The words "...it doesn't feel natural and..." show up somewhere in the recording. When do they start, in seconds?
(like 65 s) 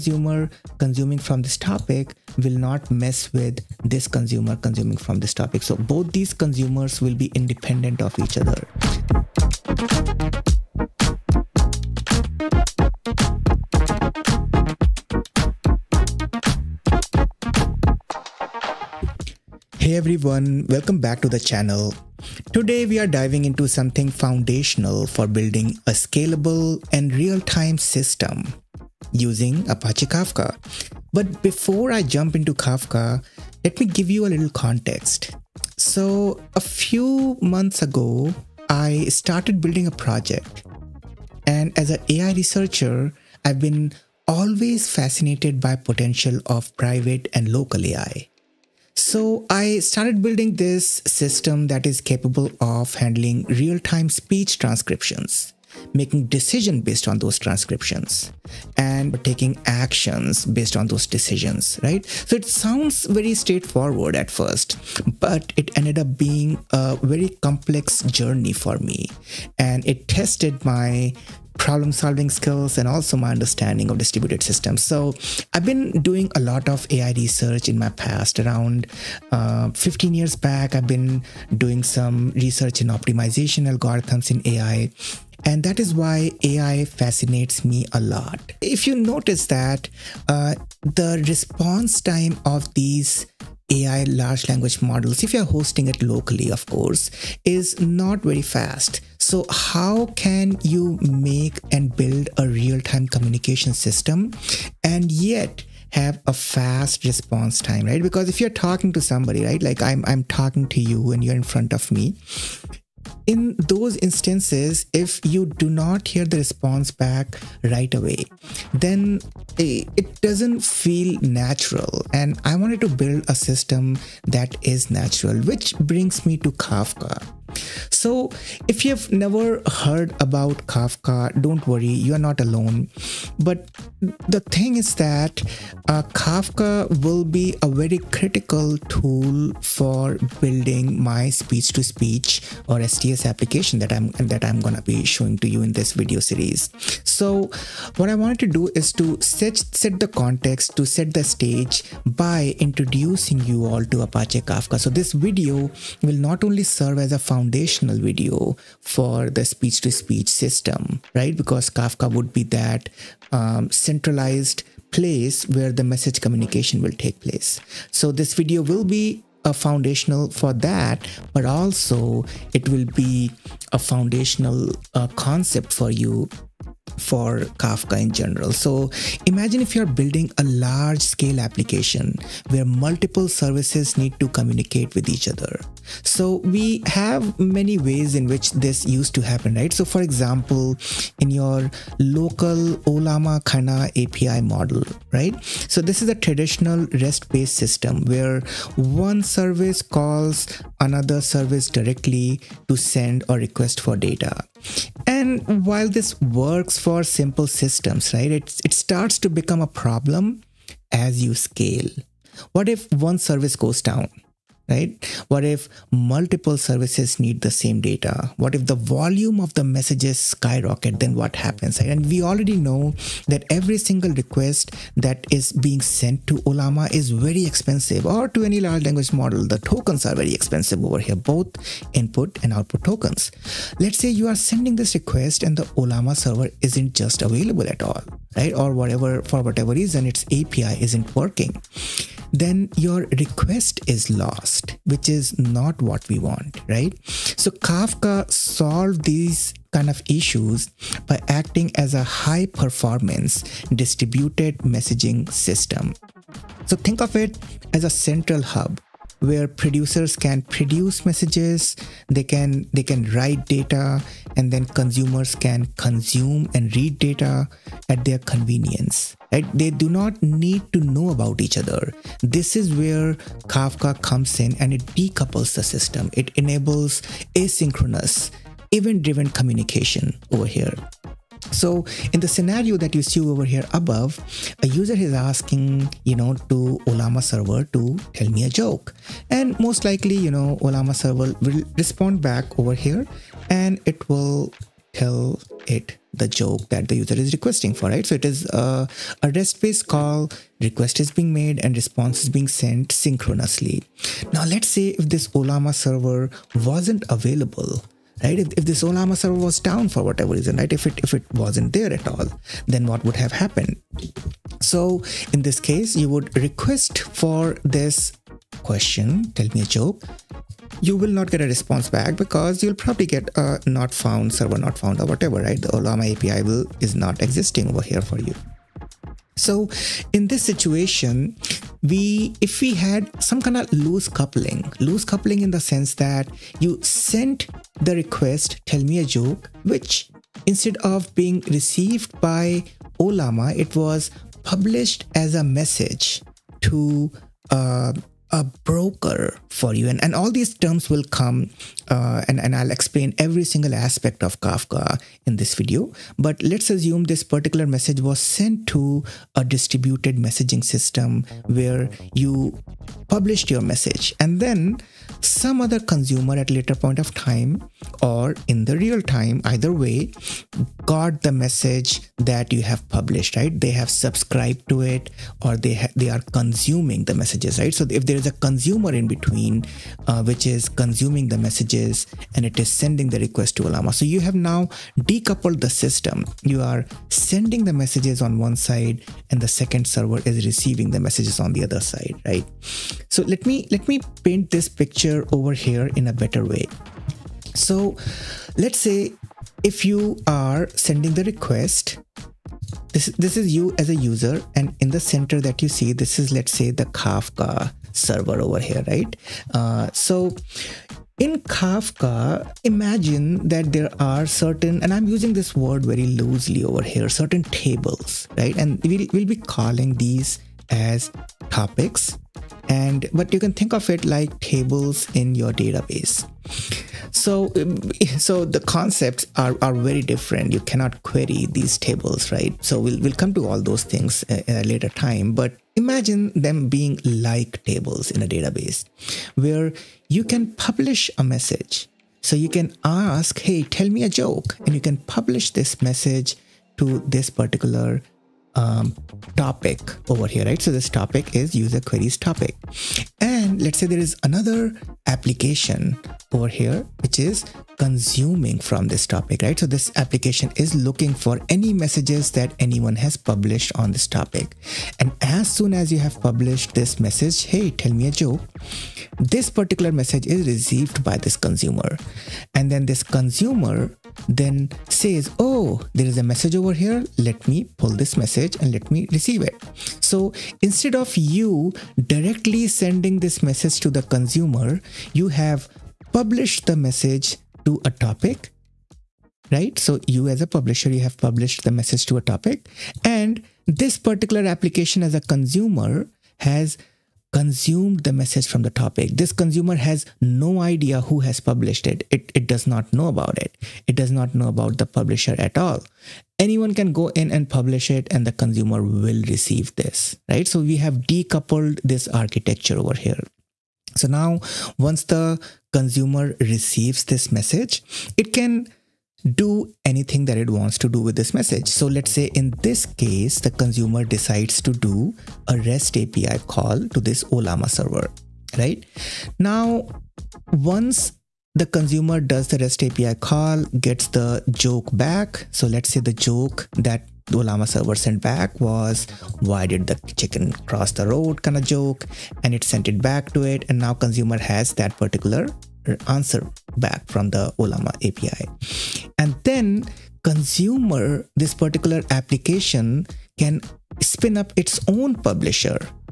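119 s.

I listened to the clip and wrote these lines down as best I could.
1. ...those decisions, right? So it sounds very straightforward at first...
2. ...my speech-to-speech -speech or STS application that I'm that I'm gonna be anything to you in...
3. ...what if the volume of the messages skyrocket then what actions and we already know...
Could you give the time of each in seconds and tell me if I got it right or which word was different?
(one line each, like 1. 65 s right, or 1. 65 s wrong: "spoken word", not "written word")
1. 60 s right
2. 141 s wrong: "showing", not "anything"
3. 218 s wrong: "happens", not "actions".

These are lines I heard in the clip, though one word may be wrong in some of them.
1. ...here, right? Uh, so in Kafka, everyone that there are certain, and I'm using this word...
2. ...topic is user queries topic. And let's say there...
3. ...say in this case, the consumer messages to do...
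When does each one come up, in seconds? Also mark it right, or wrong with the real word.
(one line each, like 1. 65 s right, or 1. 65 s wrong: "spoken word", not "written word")
1. 408 s wrong: "imagine", not "everyone"
2. 450 s right
3. 522 s wrong: "decides", not "messages".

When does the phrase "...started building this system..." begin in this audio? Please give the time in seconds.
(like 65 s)
49 s.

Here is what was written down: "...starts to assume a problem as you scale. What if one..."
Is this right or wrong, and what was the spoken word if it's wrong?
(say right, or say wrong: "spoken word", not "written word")
wrong: "become", not "assume".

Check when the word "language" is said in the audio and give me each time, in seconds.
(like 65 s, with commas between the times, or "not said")
94 s, 228 s.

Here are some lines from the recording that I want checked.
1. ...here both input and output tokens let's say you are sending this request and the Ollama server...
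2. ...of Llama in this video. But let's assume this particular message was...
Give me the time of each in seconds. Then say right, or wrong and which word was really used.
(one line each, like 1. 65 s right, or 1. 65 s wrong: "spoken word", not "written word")
1. 230 s right
2. 354 s wrong: "Kafka", not "Llama".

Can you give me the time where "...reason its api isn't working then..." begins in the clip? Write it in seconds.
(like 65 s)
239 s.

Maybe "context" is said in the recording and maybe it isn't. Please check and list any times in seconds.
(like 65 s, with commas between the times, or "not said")
34 s, 150 s.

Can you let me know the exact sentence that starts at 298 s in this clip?
So it is uh, a REST-based call, request is being made and response is being sent synchronously.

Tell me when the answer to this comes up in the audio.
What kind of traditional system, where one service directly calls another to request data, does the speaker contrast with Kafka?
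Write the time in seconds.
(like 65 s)
196 s.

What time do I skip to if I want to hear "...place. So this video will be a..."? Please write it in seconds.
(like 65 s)
167 s.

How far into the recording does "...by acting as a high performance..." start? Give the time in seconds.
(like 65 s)
251 s.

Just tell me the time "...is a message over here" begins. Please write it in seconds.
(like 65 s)
476 s.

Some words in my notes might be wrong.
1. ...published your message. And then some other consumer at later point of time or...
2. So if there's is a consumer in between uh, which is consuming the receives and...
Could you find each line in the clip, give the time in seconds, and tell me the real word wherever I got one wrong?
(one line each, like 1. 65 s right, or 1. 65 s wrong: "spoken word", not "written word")
1. 363 s right
2. 377 s wrong: "messages", not "receives".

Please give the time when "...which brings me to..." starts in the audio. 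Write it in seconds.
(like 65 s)
125 s.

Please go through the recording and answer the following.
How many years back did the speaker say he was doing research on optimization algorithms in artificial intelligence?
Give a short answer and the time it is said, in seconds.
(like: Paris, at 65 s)
15, at 79 s.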